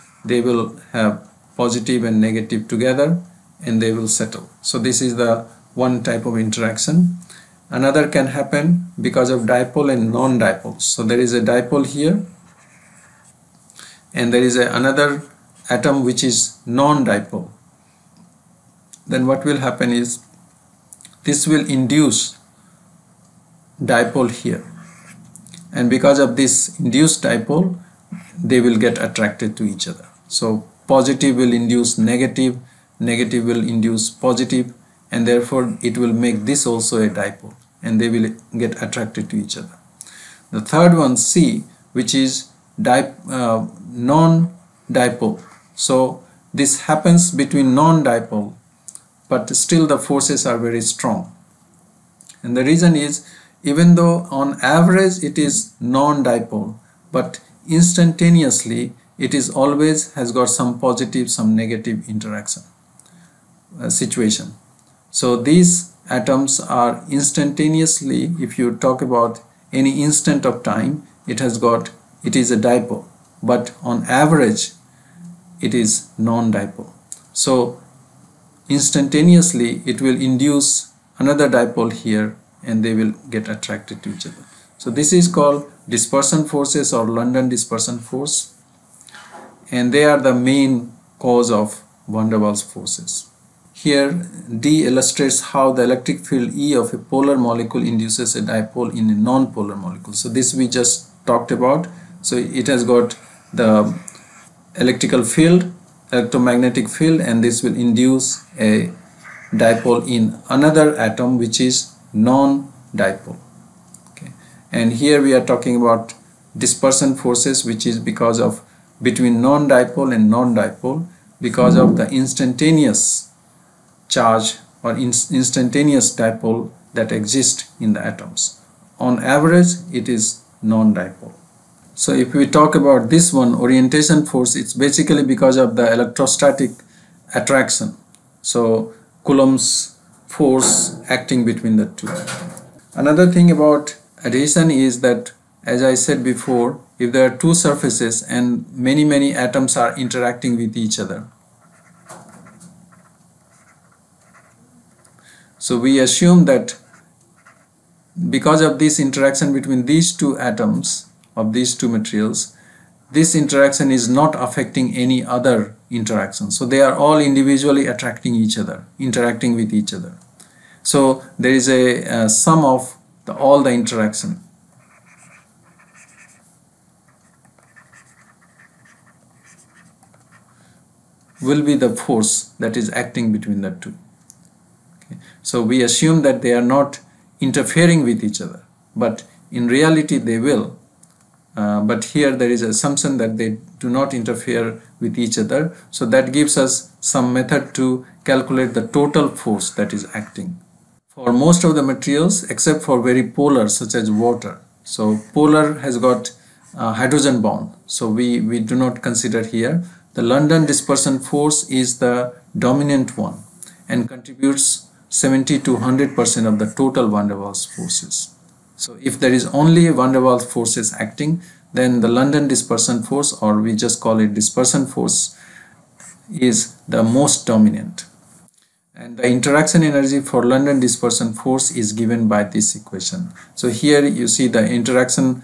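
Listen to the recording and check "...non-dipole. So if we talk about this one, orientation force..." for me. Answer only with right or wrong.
right.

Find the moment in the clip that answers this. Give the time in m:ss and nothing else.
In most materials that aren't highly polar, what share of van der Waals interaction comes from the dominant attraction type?
3:35.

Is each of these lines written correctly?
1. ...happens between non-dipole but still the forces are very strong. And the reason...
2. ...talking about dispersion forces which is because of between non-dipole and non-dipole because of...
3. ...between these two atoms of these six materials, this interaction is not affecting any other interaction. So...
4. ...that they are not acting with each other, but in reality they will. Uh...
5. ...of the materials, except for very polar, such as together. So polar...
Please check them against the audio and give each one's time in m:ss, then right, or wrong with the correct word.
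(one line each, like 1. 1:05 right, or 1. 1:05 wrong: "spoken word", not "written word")
1. 0:46 right
2. 1:55 right
3. 2:39 wrong: "two", not "six"
4. 3:06 wrong: "interfering", not "acting"
5. 3:21 wrong: "water", not "together".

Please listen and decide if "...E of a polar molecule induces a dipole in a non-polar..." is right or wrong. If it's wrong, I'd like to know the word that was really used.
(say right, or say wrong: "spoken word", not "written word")
right.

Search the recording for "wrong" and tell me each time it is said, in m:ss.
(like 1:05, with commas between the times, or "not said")
not said.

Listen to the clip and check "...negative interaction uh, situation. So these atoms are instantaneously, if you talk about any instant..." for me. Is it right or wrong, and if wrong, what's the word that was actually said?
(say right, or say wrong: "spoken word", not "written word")
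right.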